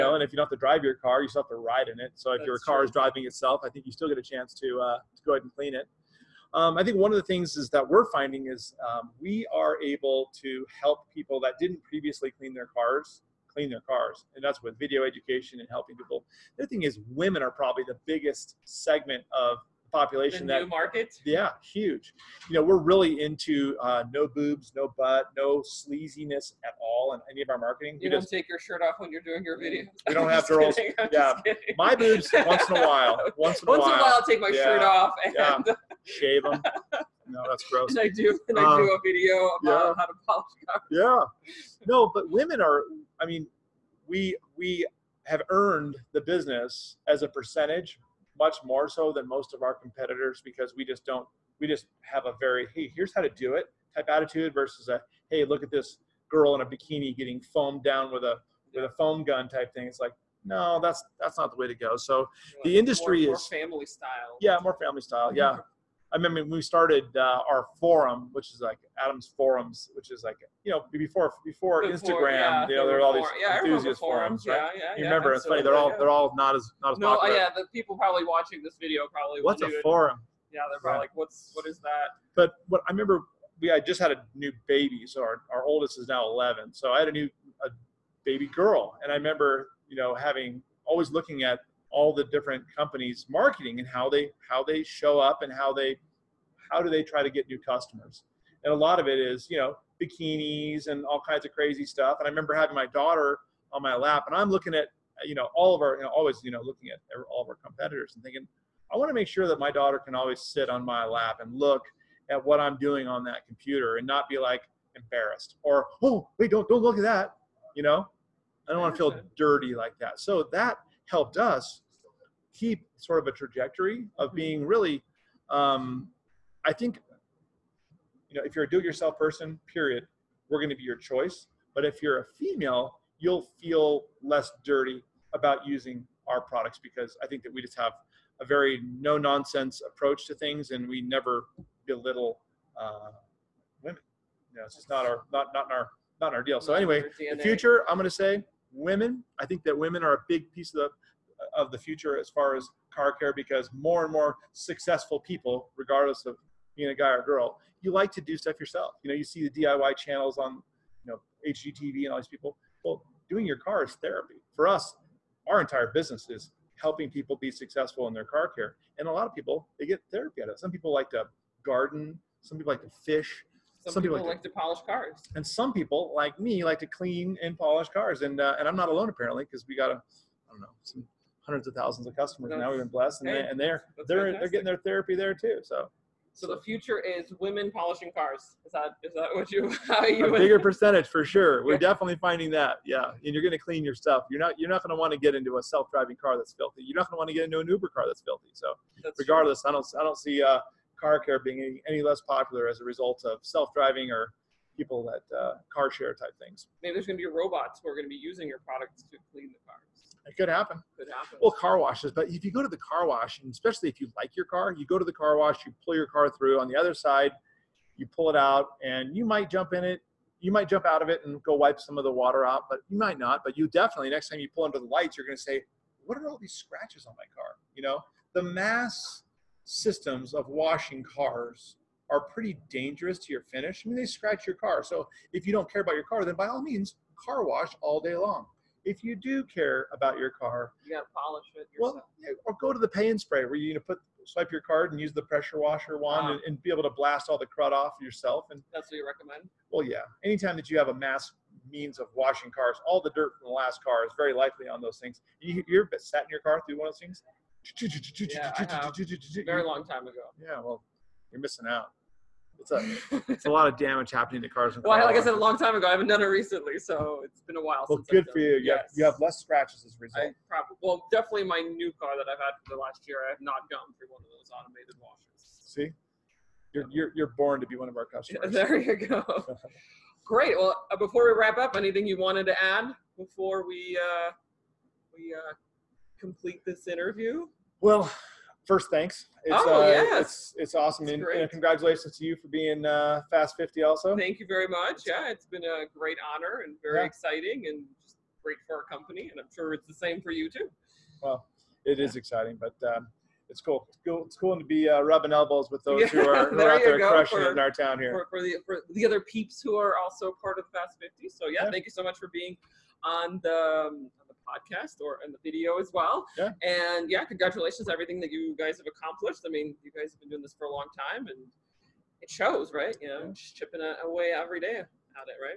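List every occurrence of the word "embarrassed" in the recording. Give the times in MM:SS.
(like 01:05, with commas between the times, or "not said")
01:54.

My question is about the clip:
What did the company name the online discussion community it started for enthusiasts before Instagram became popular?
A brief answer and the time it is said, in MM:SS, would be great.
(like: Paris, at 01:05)
Adam's forums, at 01:09.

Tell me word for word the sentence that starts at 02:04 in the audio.
being really, um, I think, you know, if you're a do-it-yourself person, period, we're going to be your choice.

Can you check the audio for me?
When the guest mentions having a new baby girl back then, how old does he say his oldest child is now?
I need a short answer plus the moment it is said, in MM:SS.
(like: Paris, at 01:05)
11, at 01:26.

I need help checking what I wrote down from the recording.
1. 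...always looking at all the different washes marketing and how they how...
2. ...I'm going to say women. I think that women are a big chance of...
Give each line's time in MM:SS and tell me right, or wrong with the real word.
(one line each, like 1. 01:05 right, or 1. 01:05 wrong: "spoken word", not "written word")
1. 01:30 wrong: "companies", not "washes"
2. 02:27 wrong: "piece", not "chance".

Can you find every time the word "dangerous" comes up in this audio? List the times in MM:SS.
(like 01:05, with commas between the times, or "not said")
03:52.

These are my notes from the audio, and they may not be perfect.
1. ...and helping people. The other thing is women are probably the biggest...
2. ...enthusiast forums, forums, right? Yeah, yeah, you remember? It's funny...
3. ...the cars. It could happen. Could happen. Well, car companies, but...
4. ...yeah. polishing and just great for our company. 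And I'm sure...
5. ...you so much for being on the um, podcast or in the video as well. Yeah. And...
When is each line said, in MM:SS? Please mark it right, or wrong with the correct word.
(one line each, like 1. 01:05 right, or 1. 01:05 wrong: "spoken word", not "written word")
1. 00:15 right
2. 01:13 right
3. 03:29 wrong: "washes", not "companies"
4. 04:57 wrong: "exciting", not "polishing"
5. 05:11 right.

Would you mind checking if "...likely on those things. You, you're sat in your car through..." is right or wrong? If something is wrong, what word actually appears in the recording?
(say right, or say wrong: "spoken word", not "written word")
right.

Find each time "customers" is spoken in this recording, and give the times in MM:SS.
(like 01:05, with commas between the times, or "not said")
01:37, 03:02, 04:38.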